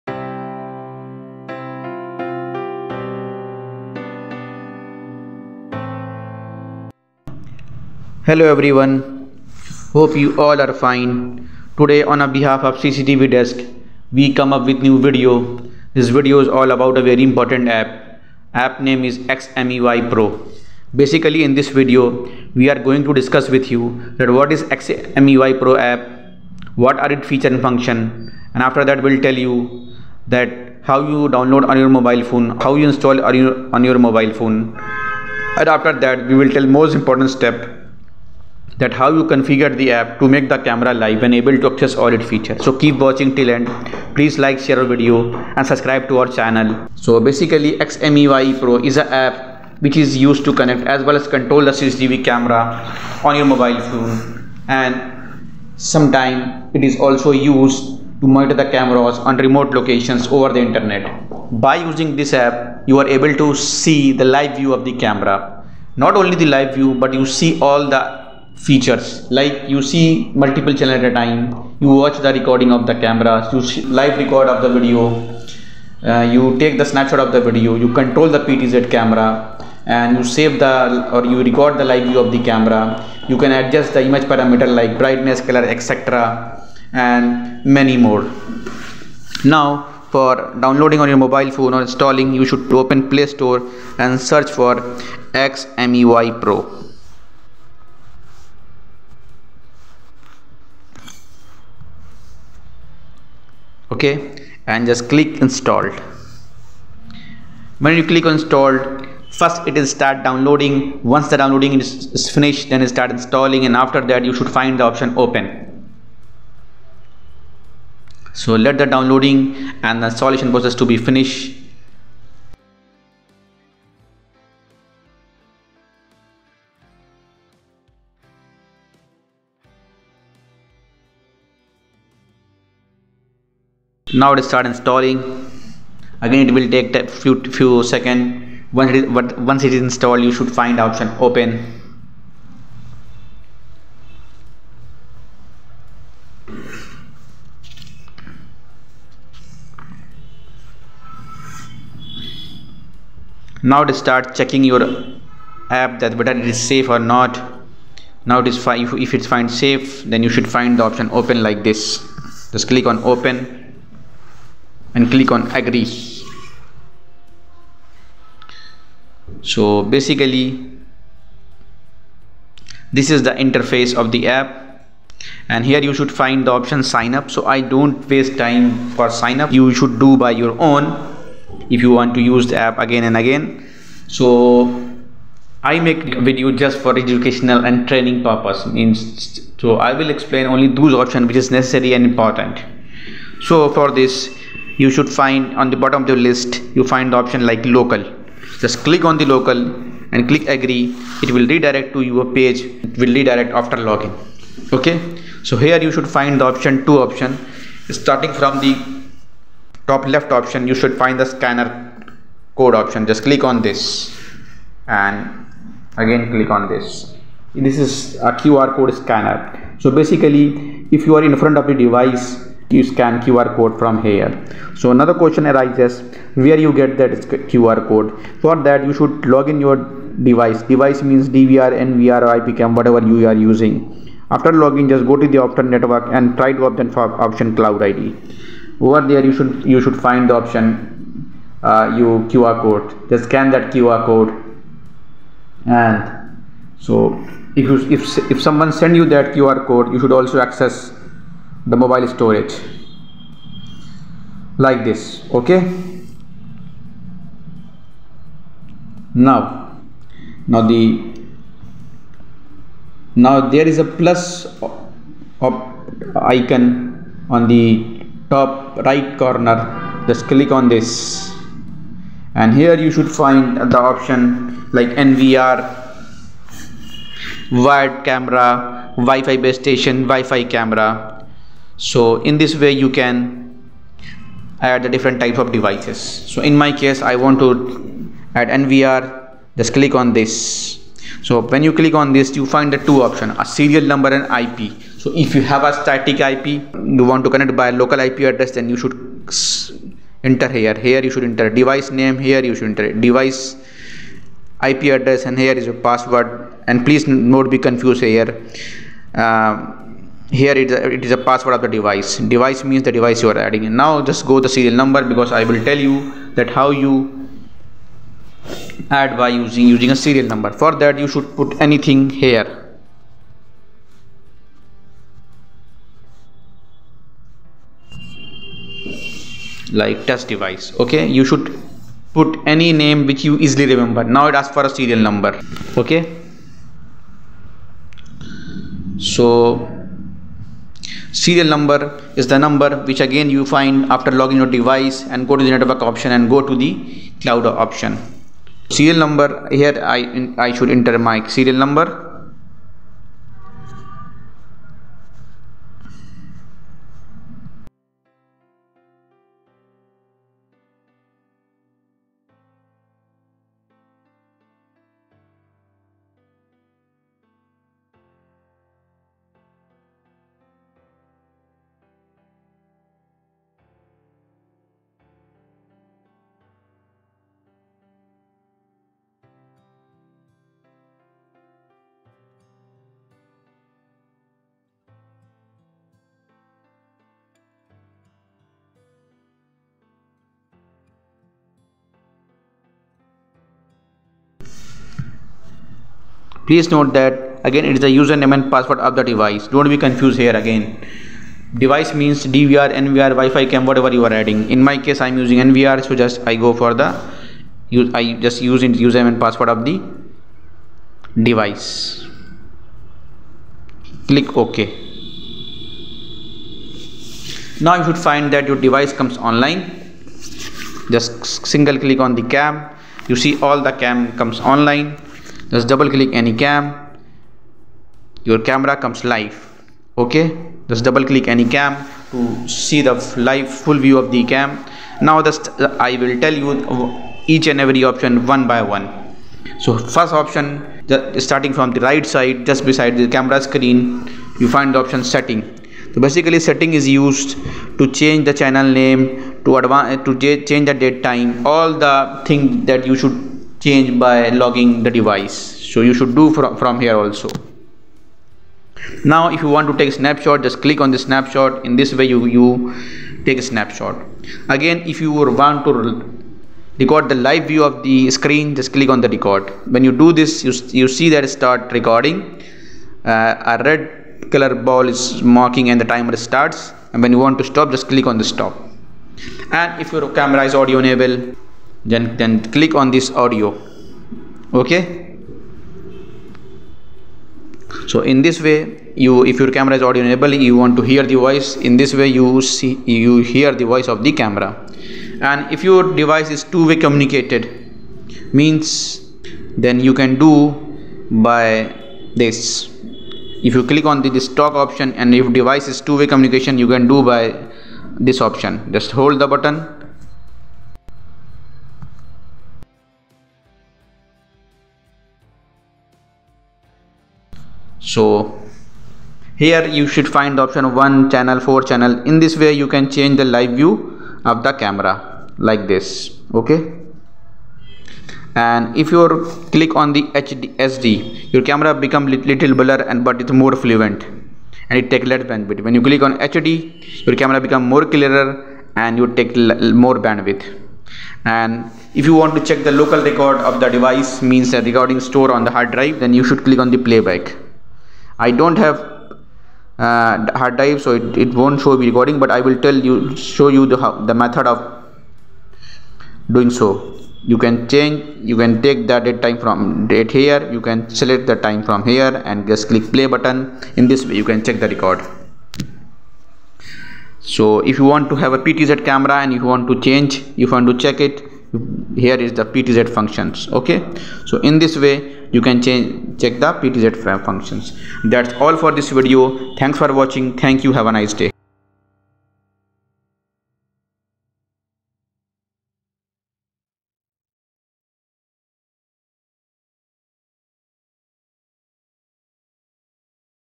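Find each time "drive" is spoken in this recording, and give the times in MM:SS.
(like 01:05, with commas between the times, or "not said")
09:05, 09:10.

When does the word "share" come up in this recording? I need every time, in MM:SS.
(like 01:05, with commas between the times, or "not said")
00:44.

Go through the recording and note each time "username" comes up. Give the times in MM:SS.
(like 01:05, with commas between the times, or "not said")
06:37, 06:48.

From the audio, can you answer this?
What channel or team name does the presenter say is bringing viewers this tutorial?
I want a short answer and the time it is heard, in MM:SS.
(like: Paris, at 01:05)
CCTV Desk, at 00:12.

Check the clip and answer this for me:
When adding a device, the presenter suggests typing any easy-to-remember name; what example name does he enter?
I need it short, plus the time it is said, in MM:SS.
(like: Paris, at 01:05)
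test device, at 05:30.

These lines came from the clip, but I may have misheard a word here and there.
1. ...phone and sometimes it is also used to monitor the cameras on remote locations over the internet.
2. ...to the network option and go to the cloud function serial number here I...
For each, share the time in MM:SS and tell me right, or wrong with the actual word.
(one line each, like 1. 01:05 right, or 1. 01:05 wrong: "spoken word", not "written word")
1. 00:53 right
2. 05:45 wrong: "option", not "function".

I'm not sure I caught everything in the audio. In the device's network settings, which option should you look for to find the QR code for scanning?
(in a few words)
cloud ID.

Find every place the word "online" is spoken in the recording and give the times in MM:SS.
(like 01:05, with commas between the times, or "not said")
06:59, 07:04.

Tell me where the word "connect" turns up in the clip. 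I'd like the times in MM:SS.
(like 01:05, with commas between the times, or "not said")
00:50, 04:57.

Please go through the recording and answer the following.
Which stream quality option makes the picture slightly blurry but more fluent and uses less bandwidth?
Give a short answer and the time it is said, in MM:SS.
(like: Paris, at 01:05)
SD, at 08:50.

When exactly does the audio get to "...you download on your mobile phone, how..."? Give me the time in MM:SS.
00:30.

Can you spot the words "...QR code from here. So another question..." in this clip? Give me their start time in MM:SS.
03:43.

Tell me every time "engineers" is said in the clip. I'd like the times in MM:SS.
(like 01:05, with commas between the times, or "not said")
not said.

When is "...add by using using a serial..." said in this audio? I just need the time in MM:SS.
05:18.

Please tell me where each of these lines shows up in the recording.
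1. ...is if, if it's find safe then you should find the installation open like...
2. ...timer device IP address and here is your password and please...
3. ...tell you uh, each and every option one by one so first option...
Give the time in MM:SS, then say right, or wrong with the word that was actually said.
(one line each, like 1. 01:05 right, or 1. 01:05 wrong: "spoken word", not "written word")
1. 02:38 wrong: "option", not "installation"
2. 05:02 wrong: "enter", not "timer"
3. 07:16 right.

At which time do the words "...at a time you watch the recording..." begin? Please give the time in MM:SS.
01:10.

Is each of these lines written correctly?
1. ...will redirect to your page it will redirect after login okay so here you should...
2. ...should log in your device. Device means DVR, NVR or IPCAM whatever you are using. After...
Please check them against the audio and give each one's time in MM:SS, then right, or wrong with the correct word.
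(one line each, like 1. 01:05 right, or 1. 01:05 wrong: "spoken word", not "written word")
1. 03:21 right
2. 03:48 right.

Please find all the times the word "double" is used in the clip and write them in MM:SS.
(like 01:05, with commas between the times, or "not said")
07:05, 07:10.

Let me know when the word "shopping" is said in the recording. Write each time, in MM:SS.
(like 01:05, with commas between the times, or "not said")
not said.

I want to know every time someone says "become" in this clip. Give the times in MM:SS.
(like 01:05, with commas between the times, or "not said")
08:51, 08:57.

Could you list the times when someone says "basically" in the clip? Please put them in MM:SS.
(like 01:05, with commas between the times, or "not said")
00:20, 00:47, 02:49, 03:40, 07:26.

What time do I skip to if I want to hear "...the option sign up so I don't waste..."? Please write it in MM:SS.
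02:56.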